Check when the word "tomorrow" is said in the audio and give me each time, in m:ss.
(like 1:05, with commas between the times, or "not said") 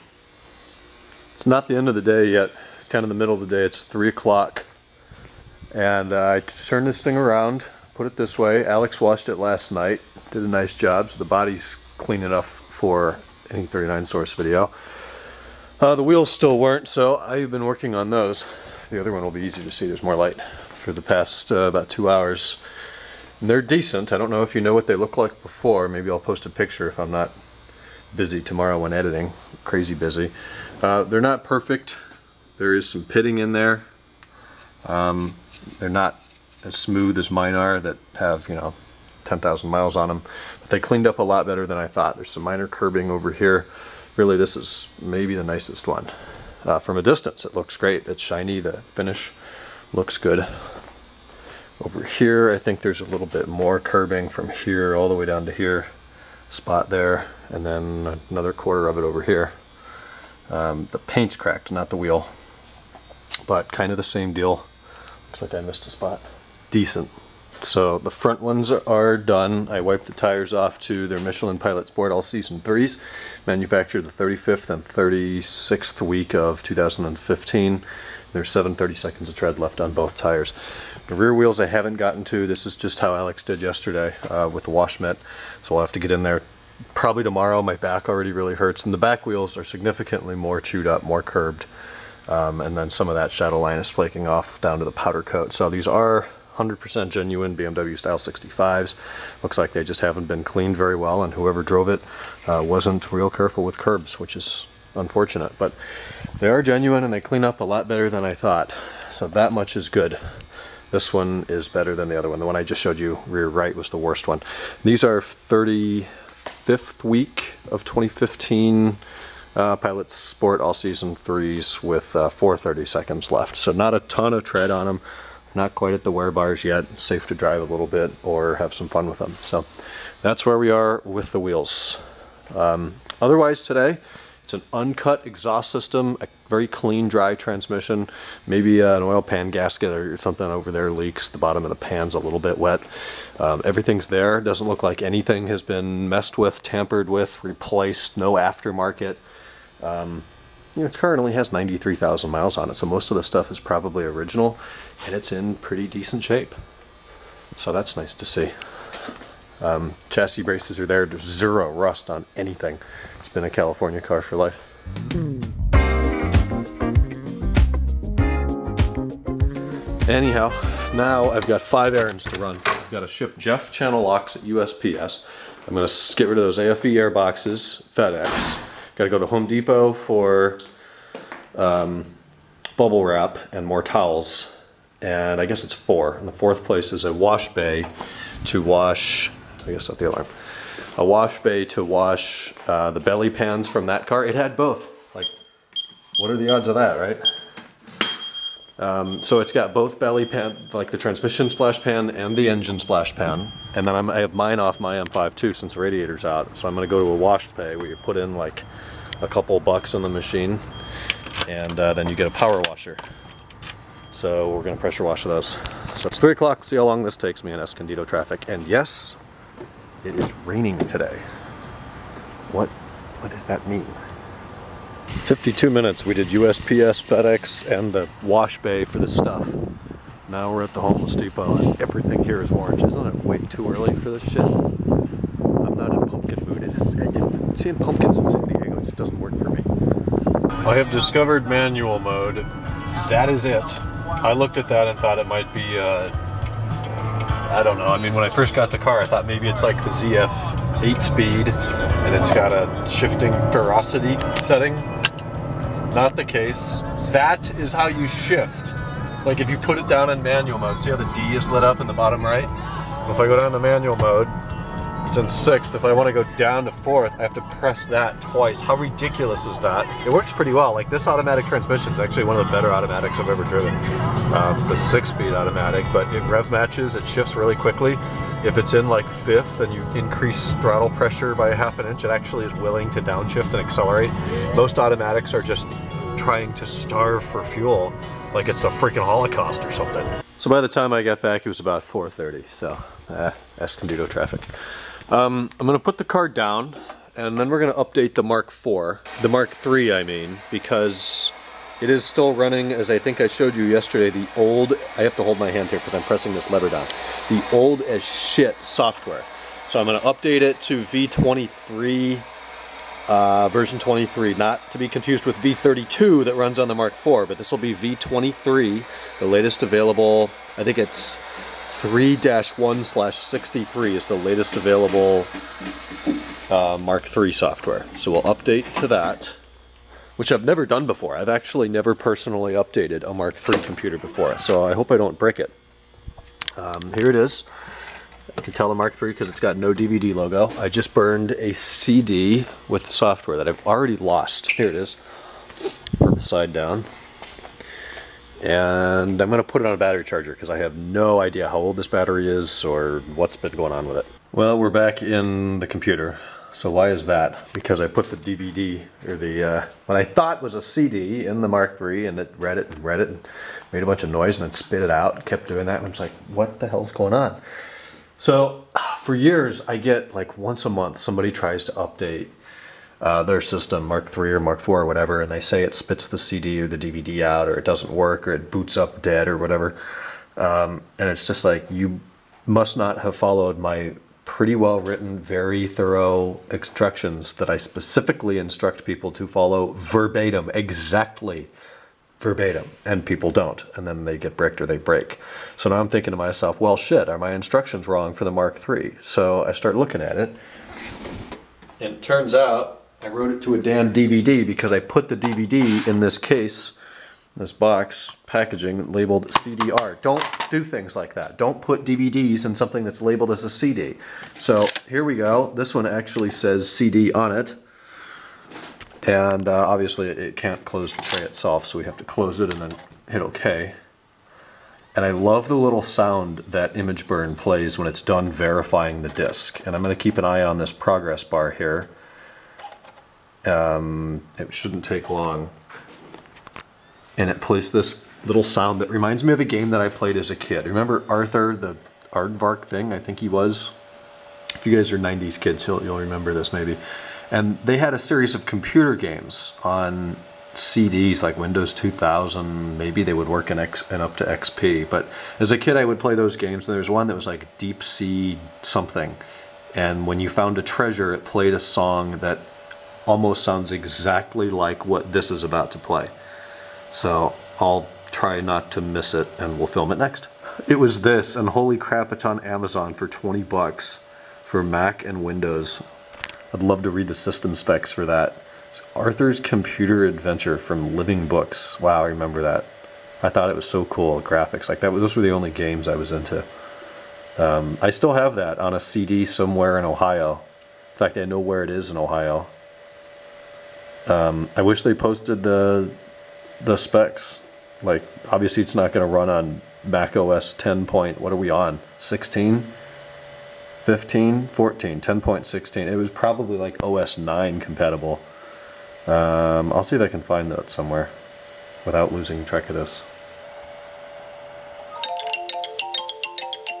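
0:28, 1:27.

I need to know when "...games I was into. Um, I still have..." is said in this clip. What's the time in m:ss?
8:05.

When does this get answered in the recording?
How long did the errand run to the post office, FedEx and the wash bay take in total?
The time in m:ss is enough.
3:45.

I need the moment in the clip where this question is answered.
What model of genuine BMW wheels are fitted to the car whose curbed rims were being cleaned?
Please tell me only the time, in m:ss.
1:37.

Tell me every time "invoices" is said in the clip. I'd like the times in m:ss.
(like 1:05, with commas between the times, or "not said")
not said.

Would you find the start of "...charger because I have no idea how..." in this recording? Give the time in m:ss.
5:50.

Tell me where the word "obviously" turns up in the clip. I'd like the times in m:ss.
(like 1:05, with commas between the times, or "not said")
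6:59, 8:18.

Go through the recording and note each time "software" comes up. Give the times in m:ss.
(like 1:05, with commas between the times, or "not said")
5:08, 5:27, 5:42.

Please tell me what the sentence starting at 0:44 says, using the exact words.
Really, this is maybe the nicest one.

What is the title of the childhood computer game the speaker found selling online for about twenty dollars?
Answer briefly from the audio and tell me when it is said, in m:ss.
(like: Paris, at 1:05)
Arthur's Computer Adventure, at 7:58.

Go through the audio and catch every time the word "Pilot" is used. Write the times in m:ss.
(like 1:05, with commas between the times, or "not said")
1:11, 1:59.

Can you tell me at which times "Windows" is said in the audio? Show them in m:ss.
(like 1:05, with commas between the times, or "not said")
7:31, 7:55.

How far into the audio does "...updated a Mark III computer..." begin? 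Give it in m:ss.
5:32.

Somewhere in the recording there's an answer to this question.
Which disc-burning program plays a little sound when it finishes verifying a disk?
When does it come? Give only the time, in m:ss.
7:06.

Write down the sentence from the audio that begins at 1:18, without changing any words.
There's 7 seconds of tread left on both tires.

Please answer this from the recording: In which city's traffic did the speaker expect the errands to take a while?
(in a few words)
Escondido.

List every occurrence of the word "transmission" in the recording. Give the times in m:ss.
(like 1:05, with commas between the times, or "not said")
2:17, 3:20, 4:31.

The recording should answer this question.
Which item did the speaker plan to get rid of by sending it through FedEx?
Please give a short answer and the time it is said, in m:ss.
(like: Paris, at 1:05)
AFE air boxes, at 2:56.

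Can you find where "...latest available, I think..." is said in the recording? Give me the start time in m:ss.
5:19.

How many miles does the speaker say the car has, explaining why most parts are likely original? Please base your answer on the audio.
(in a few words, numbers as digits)
93,000.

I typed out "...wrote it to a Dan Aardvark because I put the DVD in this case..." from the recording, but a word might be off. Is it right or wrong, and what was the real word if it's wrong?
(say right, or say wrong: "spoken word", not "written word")
wrong: "DVD", not "Aardvark".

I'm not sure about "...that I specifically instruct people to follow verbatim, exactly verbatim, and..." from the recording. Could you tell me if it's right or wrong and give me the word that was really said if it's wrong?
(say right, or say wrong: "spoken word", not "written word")
right.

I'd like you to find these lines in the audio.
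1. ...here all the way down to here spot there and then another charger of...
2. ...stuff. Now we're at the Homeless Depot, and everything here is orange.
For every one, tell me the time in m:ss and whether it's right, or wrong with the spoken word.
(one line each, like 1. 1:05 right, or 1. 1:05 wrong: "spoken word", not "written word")
1. 0:54 wrong: "quarter", not "charger"
2. 3:49 right.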